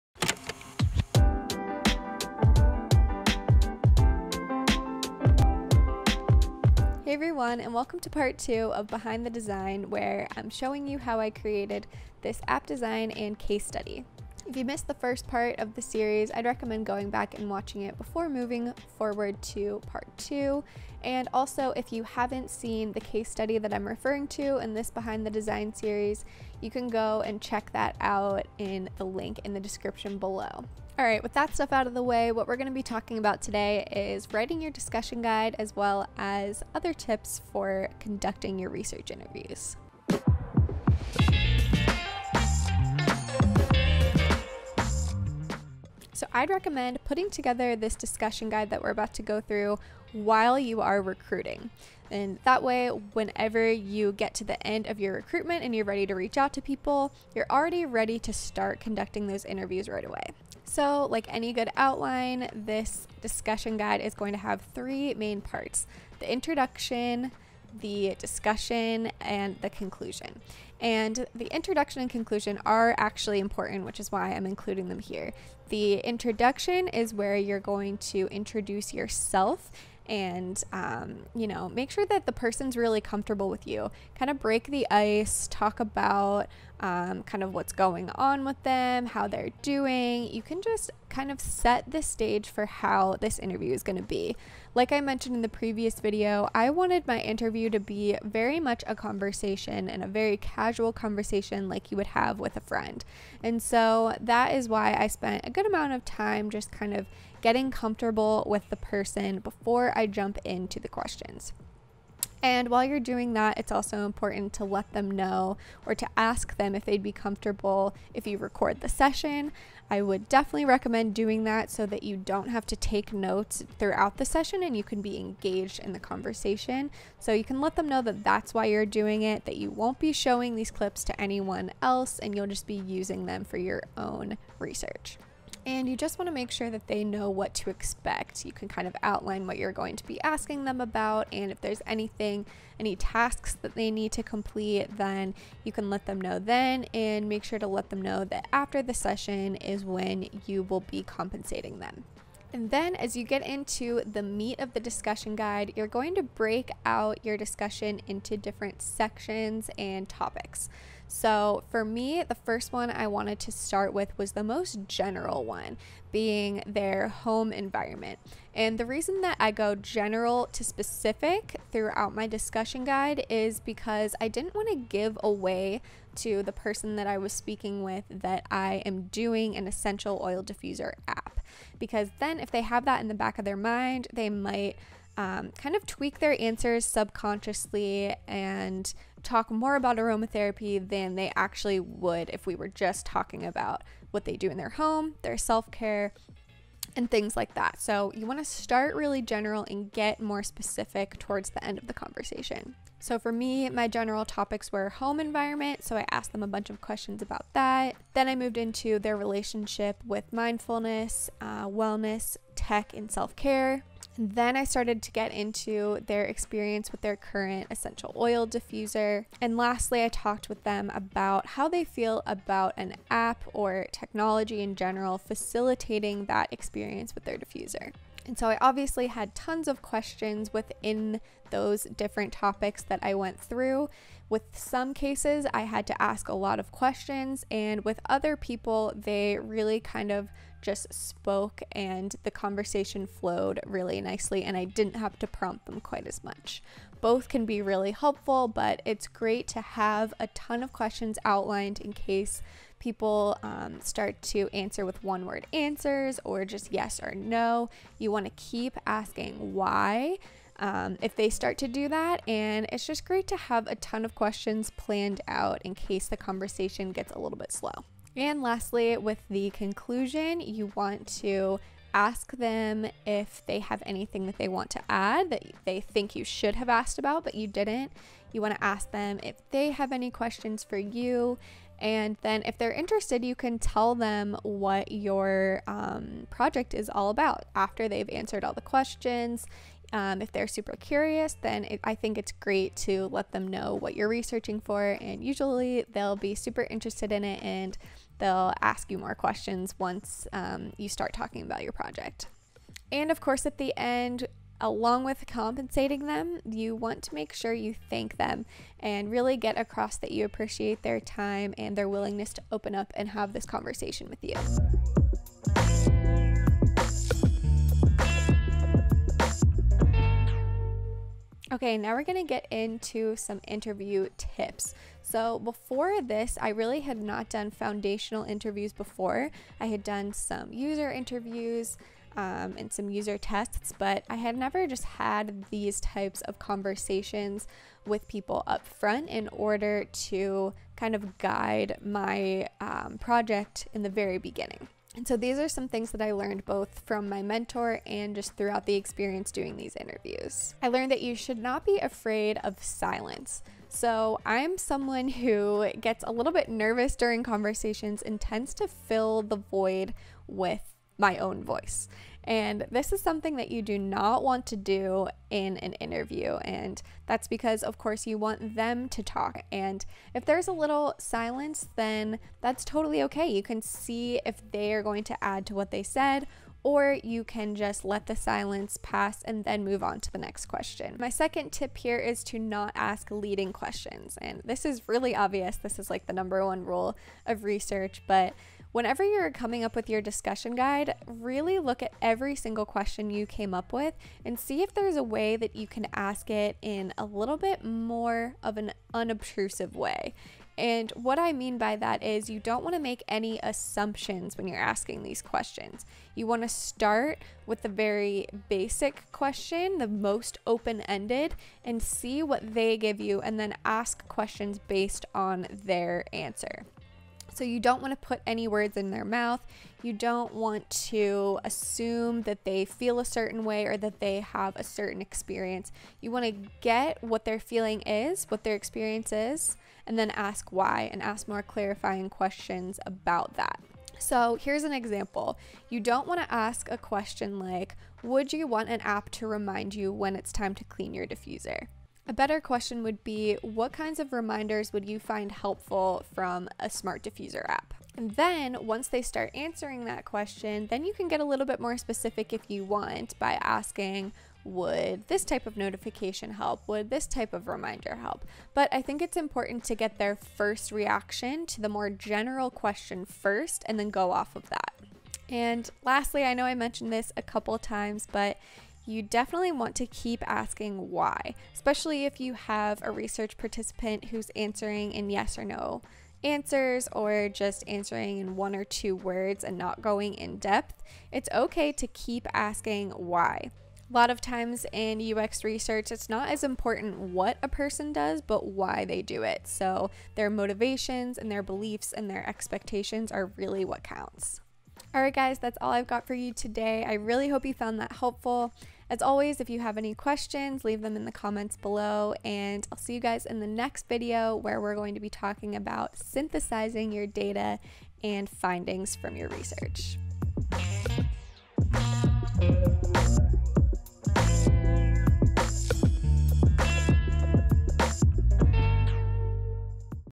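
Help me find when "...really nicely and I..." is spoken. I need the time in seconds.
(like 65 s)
243 s.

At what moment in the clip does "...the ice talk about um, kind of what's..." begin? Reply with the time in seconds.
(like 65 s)
84 s.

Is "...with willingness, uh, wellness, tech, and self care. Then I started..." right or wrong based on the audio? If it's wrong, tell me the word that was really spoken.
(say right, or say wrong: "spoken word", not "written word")
wrong: "mindfulness", not "willingness".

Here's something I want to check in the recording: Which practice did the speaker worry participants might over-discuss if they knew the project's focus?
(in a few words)
Aromatherapy.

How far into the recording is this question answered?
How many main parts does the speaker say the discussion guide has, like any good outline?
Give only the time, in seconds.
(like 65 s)
64 s.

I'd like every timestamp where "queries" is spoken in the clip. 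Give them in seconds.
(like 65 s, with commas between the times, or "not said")
not said.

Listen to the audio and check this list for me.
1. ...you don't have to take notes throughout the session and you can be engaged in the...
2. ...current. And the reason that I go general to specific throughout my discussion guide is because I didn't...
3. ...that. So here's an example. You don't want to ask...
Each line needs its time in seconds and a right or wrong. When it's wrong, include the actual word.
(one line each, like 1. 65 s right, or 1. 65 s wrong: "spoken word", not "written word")
1. 122 s right
2. 167 s wrong: "environment", not "current"
3. 433 s right.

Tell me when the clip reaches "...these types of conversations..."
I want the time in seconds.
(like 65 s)
335 s.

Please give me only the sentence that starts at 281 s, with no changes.
And then, if they're interested, you can tell them what your um, project is all about after they've answered all the questions.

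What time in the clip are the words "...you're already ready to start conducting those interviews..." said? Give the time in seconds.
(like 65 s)
57 s.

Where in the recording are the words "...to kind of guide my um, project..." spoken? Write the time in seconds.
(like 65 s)
339 s.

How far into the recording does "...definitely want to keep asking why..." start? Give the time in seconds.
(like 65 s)
469 s.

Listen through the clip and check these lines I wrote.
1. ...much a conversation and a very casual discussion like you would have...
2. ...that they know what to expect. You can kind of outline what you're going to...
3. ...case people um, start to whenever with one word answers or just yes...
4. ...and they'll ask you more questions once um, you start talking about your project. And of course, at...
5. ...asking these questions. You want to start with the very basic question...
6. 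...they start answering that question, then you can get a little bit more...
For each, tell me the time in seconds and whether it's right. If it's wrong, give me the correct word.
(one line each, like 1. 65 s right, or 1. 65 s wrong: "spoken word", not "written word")
1. 98 s wrong: "conversation", not "discussion"
2. 136 s right
3. 251 s wrong: "answer", not "whenever"
4. 297 s right
5. 404 s right
6. 448 s right.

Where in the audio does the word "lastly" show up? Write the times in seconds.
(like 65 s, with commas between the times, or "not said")
219 s, 268 s, 465 s.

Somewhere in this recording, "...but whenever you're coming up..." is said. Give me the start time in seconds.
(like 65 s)
388 s.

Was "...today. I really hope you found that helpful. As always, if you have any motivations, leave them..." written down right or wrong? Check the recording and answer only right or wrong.
wrong.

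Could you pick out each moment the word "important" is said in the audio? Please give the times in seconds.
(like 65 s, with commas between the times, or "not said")
73 s, 114 s, 459 s, 486 s.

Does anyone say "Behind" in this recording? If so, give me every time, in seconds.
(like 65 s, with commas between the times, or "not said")
8 s, 24 s.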